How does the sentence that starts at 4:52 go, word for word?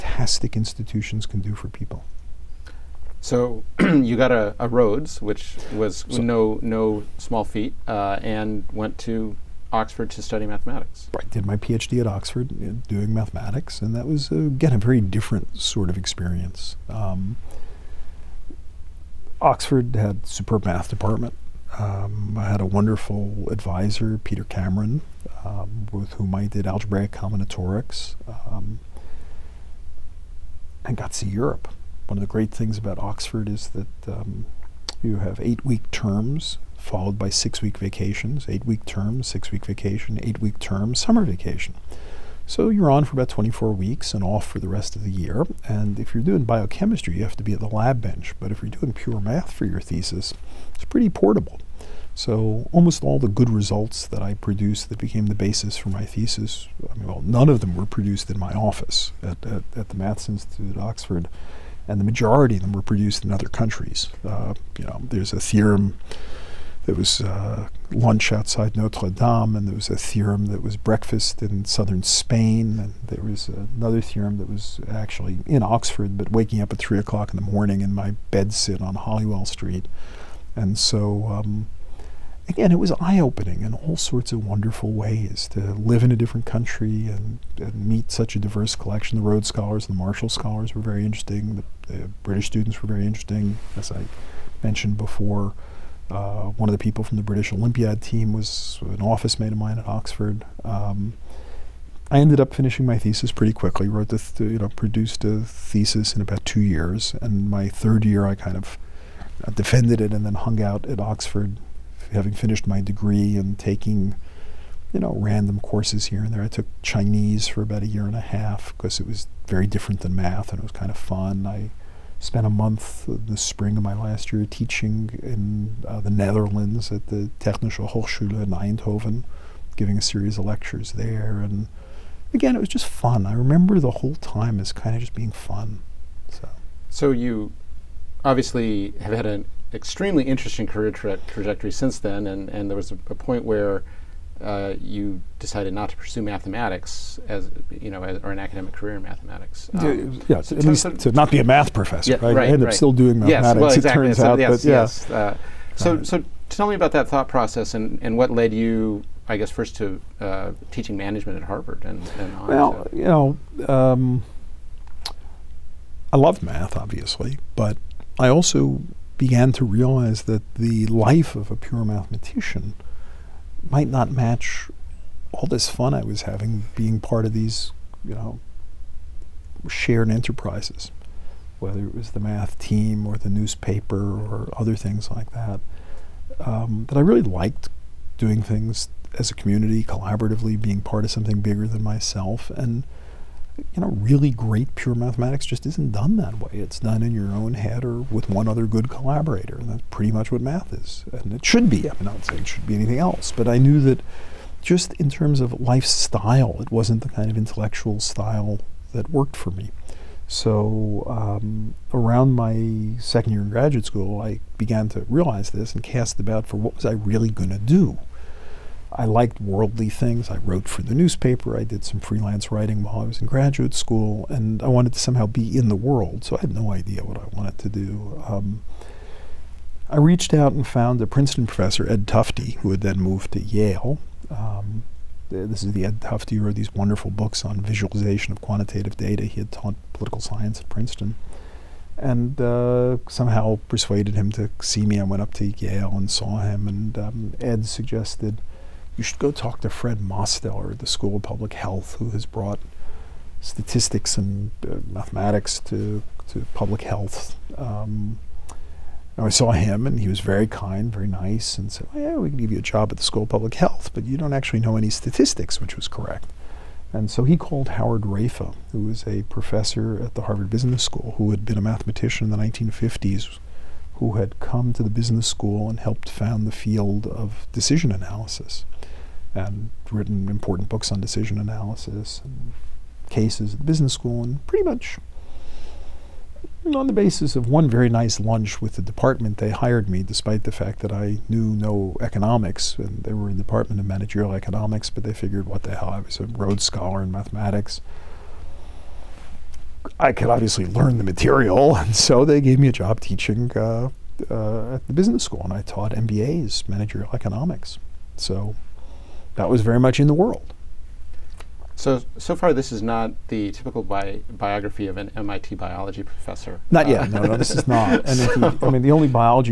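And they were in the Department of Managerial Economics, but they figured, what the hell, I was a Rhodes Scholar in mathematics.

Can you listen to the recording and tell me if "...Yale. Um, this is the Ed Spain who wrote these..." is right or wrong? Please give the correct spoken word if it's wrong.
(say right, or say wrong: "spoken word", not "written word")
wrong: "Tufte", not "Spain".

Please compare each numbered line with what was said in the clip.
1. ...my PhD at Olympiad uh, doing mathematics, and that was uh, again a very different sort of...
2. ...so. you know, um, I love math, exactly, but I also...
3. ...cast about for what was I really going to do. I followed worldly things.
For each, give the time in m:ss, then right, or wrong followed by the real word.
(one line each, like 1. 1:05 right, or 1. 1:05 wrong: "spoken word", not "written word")
1. 0:11 wrong: "Oxford", not "Olympiad"
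2. 2:42 wrong: "obviously", not "exactly"
3. 3:35 wrong: "liked", not "followed".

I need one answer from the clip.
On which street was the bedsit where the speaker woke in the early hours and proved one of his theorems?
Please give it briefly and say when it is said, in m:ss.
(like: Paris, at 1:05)
Holywell Street, at 1:18.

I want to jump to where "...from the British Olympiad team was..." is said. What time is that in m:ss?
1:37.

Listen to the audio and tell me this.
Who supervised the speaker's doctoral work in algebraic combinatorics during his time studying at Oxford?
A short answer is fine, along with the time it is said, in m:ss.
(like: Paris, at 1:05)
Peter Cameron, at 0:24.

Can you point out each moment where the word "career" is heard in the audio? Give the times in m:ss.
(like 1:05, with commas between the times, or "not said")
2:20, 2:28.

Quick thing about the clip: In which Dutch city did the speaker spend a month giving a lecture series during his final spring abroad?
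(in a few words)
Eindhoven.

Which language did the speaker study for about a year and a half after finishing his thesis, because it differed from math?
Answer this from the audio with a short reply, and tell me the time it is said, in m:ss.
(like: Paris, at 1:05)
Chinese, at 1:56.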